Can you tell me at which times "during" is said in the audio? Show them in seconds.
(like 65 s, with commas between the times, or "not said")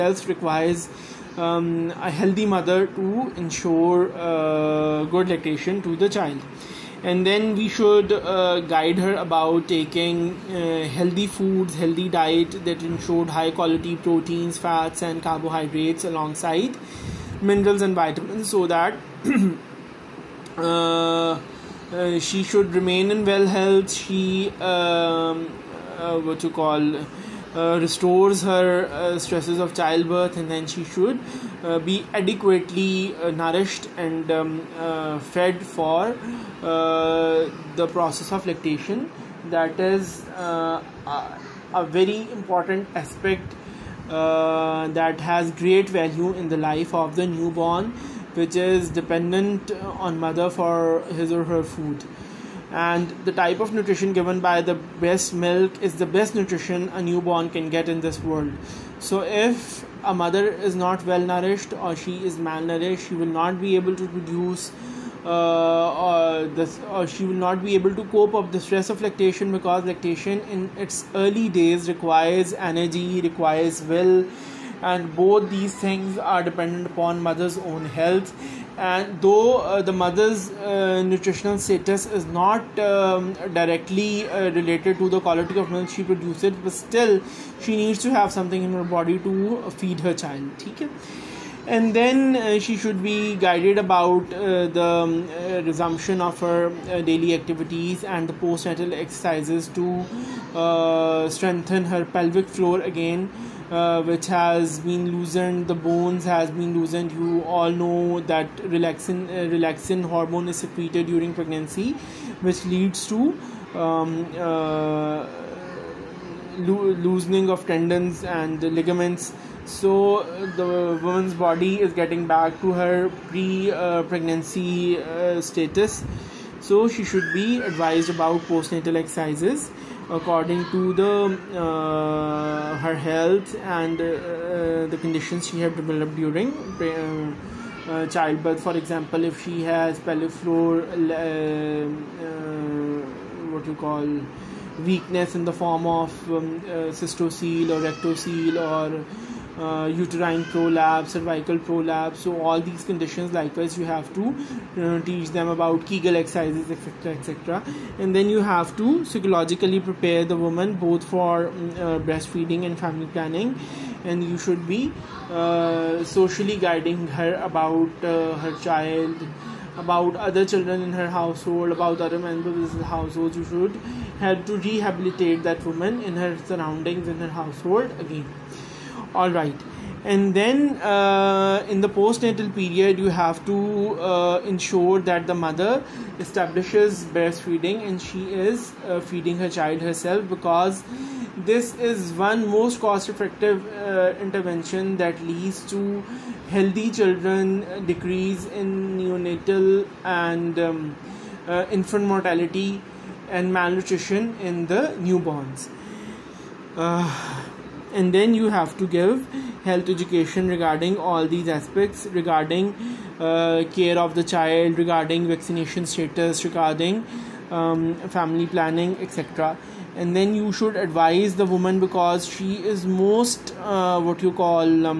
111 s, 136 s.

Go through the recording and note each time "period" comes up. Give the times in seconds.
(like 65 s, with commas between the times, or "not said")
182 s.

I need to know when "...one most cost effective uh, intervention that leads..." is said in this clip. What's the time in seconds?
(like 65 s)
192 s.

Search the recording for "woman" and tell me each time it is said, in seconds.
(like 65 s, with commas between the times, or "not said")
121 s, 160 s, 175 s, 221 s.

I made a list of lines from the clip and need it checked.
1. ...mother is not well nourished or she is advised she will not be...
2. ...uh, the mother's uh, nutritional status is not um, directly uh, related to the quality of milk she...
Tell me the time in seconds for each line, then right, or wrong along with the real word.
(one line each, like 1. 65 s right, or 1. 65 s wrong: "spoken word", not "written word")
1. 60 s wrong: "malnourished", not "advised"
2. 79 s right.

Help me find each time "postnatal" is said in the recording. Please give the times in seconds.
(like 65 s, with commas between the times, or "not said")
98 s, 128 s, 181 s.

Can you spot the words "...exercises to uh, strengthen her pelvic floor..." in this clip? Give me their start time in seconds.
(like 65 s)
98 s.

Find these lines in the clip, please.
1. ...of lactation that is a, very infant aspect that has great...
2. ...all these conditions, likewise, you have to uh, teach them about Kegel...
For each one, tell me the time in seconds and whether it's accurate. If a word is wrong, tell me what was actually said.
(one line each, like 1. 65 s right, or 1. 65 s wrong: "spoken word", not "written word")
1. 38 s wrong: "important", not "infant"
2. 152 s right.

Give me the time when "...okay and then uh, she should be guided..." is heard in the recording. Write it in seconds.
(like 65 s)
90 s.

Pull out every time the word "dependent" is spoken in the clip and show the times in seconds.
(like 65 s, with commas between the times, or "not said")
48 s, 76 s.